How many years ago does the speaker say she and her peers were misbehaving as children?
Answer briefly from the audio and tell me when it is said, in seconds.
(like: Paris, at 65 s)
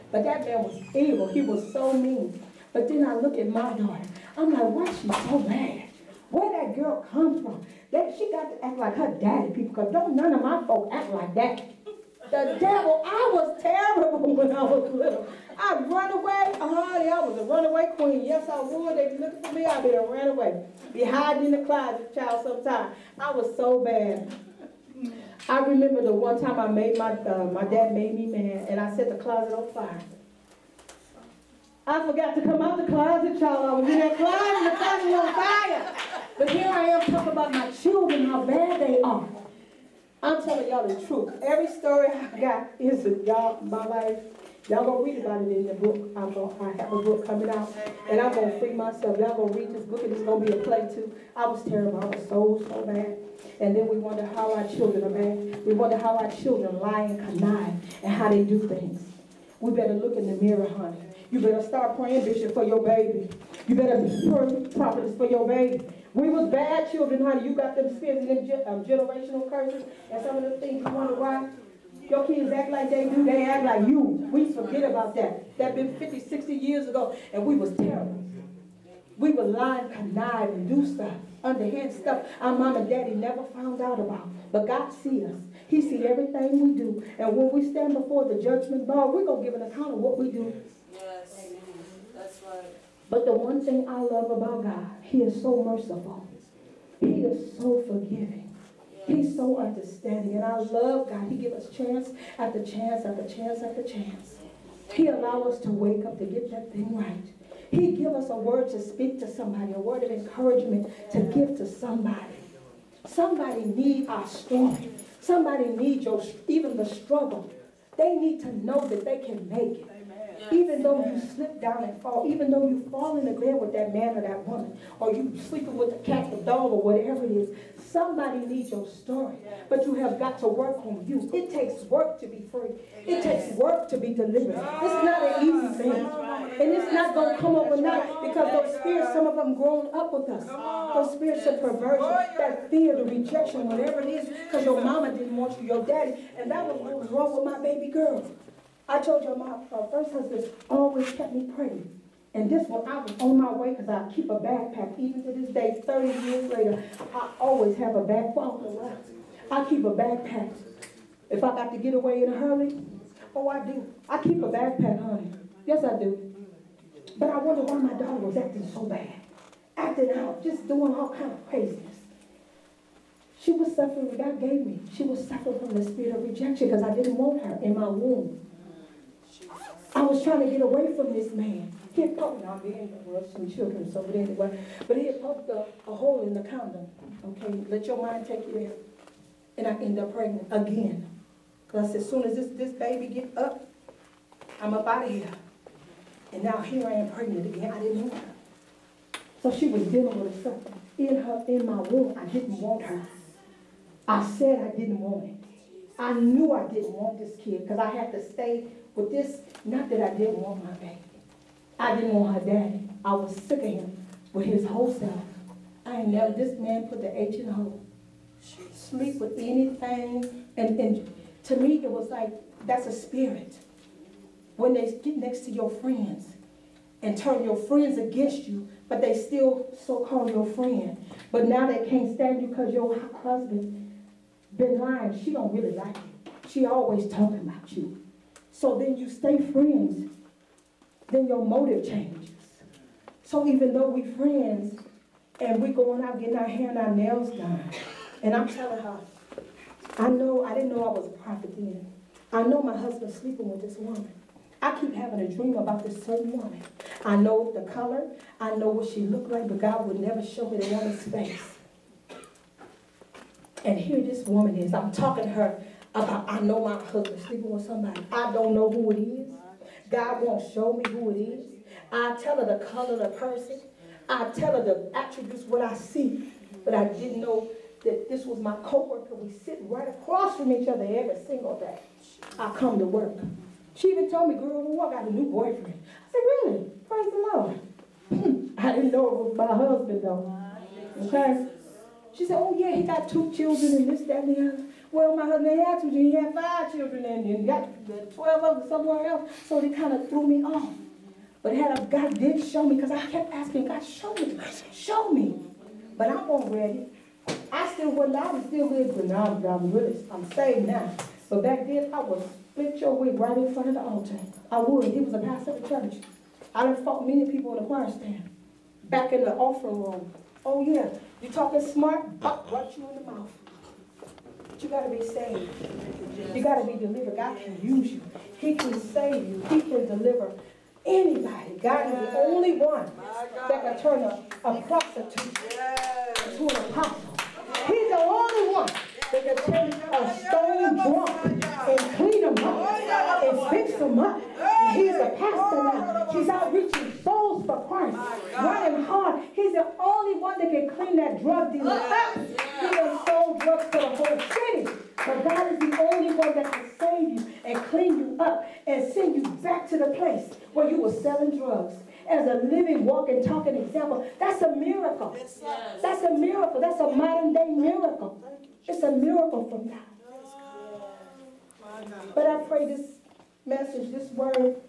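50, 60 years, at 75 s.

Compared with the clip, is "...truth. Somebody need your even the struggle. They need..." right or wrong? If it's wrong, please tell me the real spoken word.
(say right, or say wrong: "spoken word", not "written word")
wrong: "strength", not "truth".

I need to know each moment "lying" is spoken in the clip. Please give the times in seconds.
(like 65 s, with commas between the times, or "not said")
79 s, 234 s.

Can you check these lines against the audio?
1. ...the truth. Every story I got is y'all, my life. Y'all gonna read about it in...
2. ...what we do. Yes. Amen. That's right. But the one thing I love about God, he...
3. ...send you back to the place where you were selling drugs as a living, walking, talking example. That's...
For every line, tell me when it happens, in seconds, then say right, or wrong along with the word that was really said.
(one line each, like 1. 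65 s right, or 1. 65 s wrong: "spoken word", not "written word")
1. 40 s right
2. 89 s right
3. 358 s right.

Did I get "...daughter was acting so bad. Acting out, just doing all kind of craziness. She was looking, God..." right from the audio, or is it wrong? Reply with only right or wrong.
wrong.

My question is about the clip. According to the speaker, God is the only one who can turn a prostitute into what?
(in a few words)
An apostle.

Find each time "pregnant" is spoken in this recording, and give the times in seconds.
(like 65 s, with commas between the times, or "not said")
190 s, 197 s.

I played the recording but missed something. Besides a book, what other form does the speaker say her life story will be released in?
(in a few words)
A play.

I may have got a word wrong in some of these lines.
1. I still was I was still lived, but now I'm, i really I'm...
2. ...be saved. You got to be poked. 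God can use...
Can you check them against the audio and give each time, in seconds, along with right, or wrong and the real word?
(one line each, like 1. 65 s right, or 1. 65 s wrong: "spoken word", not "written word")
1. 307 s right
2. 324 s wrong: "delivered", not "poked".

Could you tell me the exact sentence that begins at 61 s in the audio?
You better start praying, Bishop, for your baby.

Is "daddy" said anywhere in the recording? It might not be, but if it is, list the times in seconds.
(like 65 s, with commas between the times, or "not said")
9 s, 82 s, 145 s, 212 s.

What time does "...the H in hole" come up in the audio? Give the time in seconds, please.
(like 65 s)
217 s.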